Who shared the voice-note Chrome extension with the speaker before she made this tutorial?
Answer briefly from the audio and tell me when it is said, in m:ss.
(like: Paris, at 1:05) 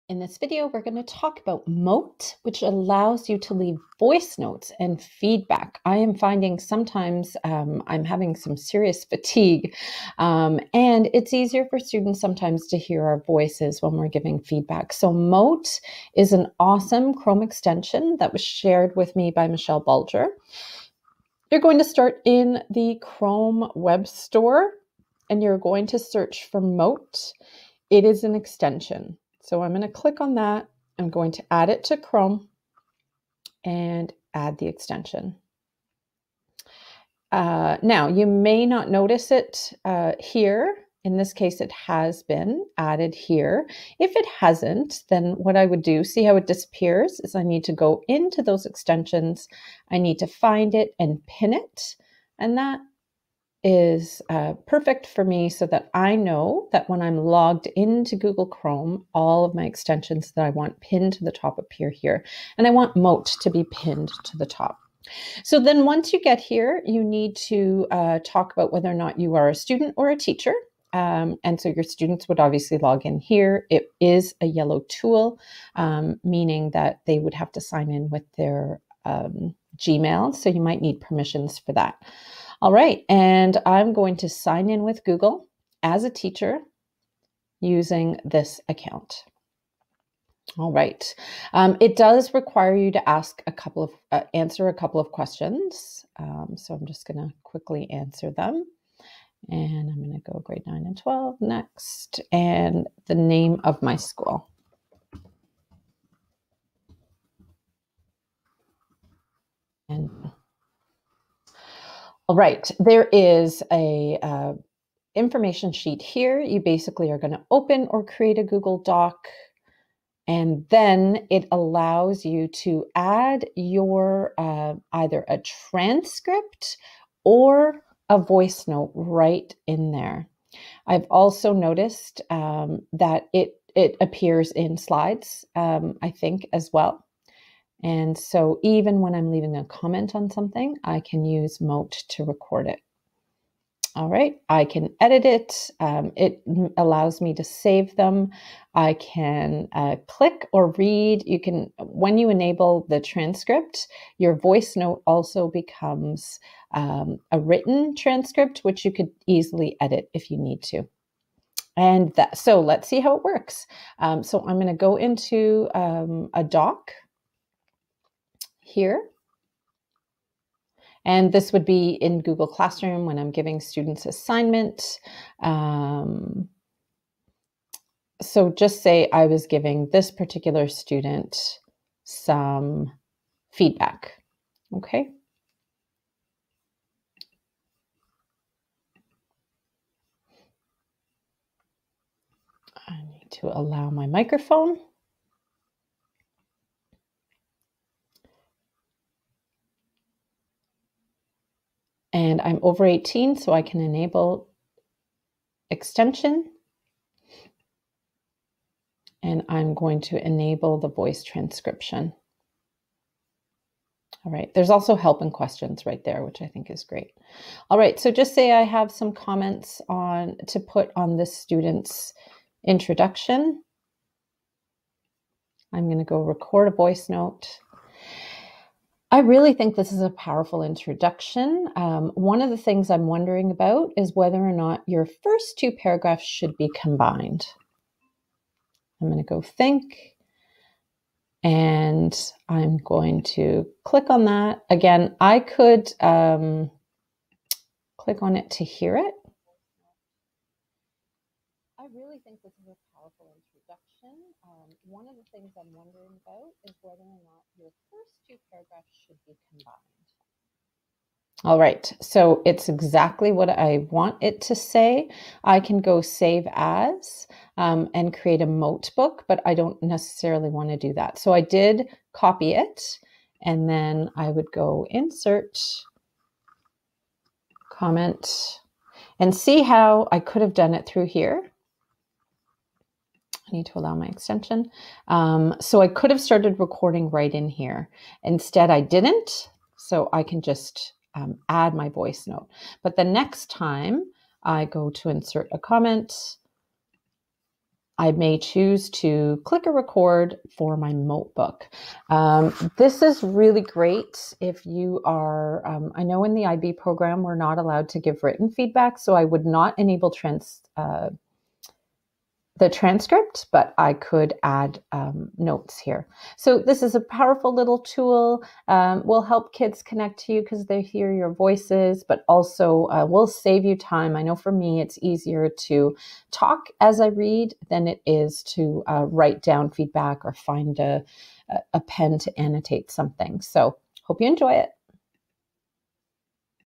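Michelle Bulger, at 0:19.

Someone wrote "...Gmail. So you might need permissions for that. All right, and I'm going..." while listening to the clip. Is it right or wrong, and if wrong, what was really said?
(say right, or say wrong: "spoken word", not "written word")
right.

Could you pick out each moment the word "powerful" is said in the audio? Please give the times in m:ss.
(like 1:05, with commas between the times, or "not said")
3:50, 4:12, 5:16.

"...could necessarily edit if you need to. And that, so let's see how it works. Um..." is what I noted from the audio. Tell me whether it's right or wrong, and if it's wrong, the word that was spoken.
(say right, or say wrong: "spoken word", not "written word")
wrong: "easily", not "necessarily".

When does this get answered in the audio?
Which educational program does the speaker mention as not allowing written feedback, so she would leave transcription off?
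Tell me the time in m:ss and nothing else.
5:06.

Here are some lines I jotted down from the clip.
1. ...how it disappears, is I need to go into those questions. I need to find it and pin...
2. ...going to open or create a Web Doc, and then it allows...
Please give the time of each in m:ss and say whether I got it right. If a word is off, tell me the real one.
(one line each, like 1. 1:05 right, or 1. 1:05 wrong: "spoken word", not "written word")
1. 0:46 wrong: "extensions", not "questions"
2. 1:57 wrong: "Google", not "Web".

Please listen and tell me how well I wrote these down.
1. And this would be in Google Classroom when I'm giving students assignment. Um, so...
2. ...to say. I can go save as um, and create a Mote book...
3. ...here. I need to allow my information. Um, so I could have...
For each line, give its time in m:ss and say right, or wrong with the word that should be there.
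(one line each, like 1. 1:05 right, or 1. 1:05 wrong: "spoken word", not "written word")
1. 2:51 right
2. 4:24 right
3. 4:41 wrong: "extension", not "information".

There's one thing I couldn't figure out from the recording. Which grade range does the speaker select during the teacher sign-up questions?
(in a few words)
9 and 12.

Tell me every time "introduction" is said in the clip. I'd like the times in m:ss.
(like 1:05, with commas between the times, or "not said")
3:42, 3:50, 4:13.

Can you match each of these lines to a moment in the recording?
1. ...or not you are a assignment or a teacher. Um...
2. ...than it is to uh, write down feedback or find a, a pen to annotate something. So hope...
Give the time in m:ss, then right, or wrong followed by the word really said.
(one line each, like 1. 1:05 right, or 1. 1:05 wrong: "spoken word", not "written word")
1. 1:08 wrong: "student", not "assignment"
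2. 5:27 right.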